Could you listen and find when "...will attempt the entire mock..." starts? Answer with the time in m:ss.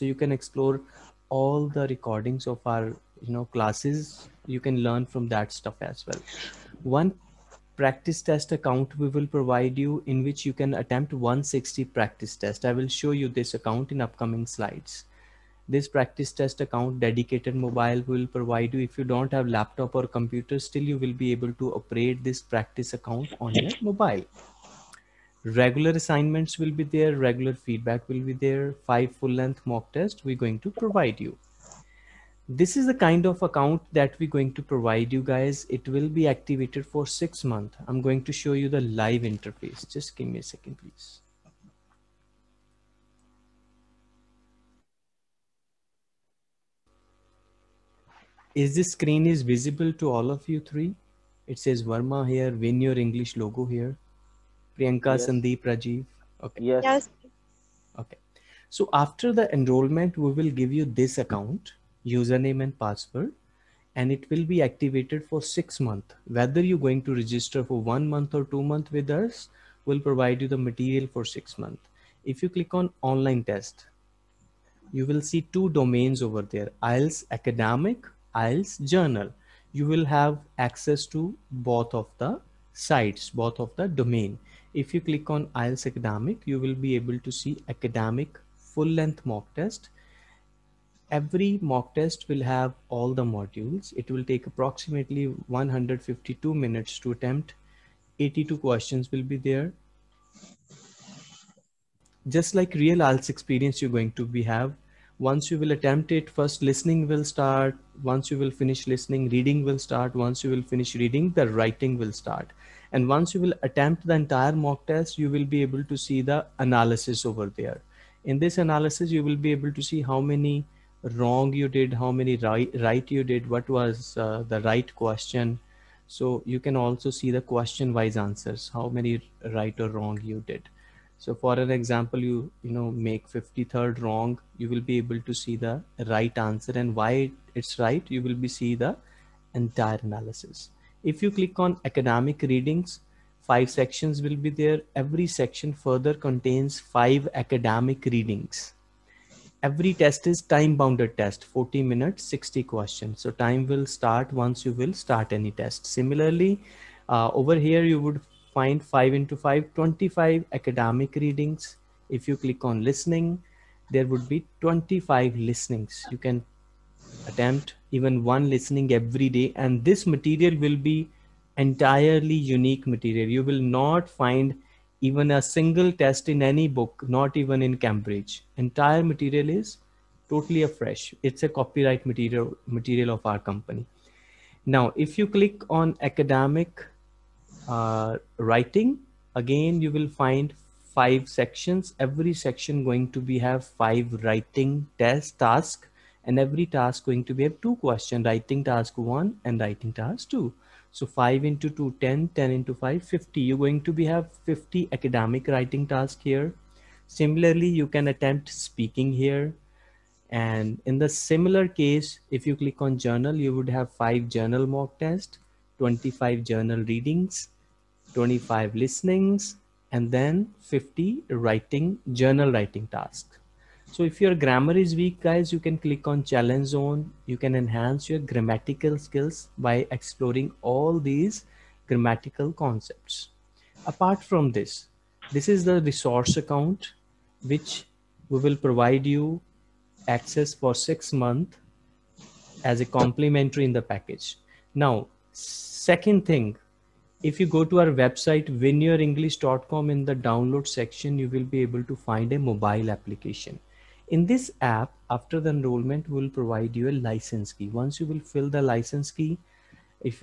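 1:53.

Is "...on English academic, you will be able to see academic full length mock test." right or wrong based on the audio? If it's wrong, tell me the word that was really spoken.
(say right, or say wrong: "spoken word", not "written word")
wrong: "IELTS", not "English".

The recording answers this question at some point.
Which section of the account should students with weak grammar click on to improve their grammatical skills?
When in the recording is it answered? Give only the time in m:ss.
3:46.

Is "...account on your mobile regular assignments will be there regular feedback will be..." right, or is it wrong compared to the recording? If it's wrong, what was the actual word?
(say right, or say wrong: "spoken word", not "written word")
right.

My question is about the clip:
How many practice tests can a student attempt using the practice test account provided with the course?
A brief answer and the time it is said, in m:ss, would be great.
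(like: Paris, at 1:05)
160, at 0:11.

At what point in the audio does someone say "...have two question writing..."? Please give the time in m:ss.
3:17.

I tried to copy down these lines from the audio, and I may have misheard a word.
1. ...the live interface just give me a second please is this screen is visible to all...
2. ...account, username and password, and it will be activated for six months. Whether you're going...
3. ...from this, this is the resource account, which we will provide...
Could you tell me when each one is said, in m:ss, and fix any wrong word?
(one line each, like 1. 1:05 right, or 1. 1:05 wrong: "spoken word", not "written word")
1. 0:38 right
2. 1:01 right
3. 3:54 right.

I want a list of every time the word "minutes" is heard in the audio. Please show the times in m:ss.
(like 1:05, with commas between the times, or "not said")
1:36, 2:31.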